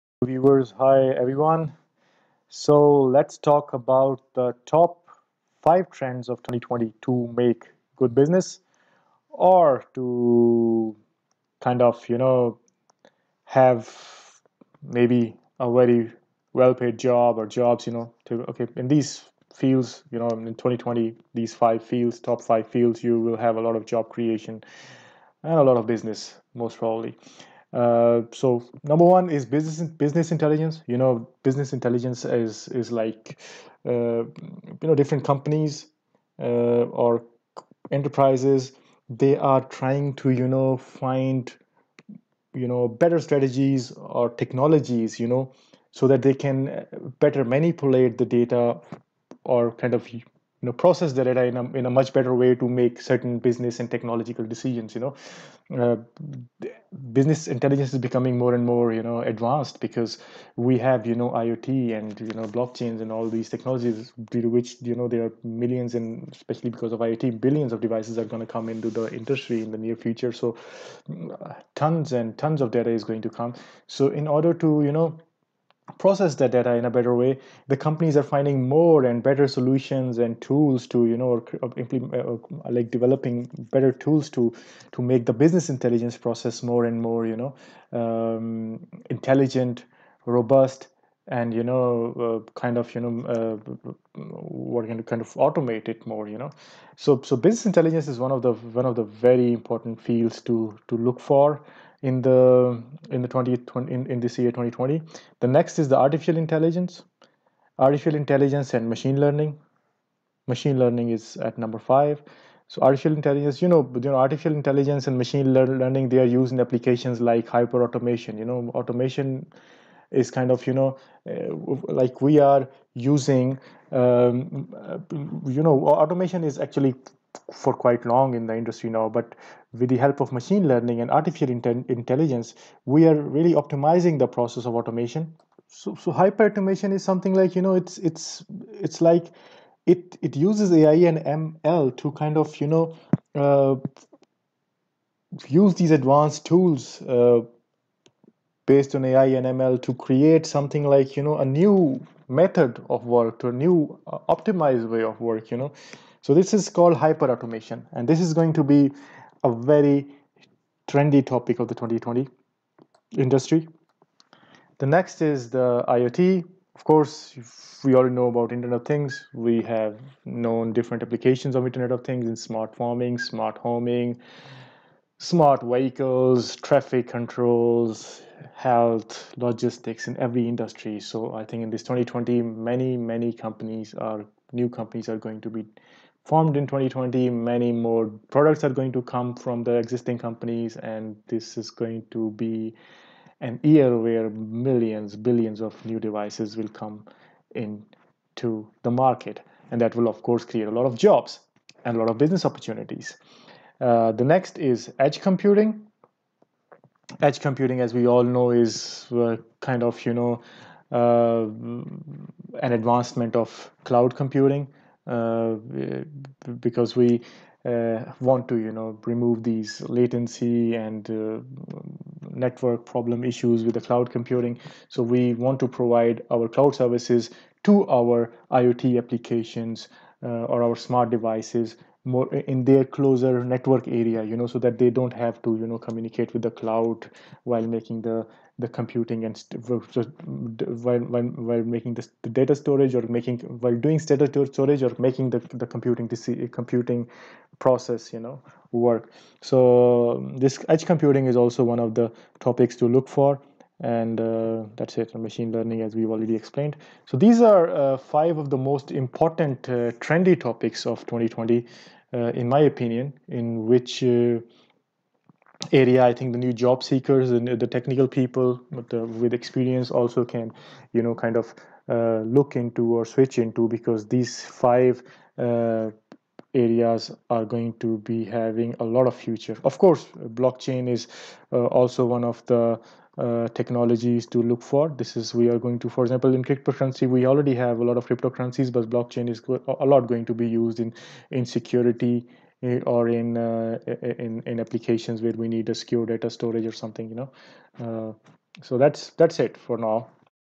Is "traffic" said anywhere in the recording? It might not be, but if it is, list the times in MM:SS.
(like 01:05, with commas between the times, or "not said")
02:56.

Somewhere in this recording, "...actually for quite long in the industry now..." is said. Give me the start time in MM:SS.
02:06.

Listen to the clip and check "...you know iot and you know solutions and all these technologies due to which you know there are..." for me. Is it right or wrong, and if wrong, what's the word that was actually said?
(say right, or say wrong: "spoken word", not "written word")
wrong: "blockchains", not "solutions".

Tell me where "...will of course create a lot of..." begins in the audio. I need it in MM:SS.
03:19.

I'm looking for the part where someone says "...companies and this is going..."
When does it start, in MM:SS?
03:10.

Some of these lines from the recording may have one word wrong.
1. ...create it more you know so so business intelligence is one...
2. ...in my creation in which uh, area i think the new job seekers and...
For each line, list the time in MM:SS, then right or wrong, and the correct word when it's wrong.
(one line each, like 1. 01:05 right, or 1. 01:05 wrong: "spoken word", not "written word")
1. 01:35 wrong: "automate", not "create"
2. 04:22 wrong: "opinion", not "creation".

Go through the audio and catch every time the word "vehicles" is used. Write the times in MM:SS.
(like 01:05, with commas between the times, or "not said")
02:55.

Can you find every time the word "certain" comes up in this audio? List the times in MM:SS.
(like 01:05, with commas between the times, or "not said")
00:53.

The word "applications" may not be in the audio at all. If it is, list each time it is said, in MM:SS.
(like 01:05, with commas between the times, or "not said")
01:56, 02:51, 03:48, 04:54.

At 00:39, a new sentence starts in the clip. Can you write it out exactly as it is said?
They are trying to you know find you know better strategies or technologies.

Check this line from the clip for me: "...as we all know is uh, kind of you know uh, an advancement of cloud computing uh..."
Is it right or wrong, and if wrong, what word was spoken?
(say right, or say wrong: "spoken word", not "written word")
right.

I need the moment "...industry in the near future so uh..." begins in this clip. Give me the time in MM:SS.
01:09.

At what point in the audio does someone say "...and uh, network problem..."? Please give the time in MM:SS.
03:40.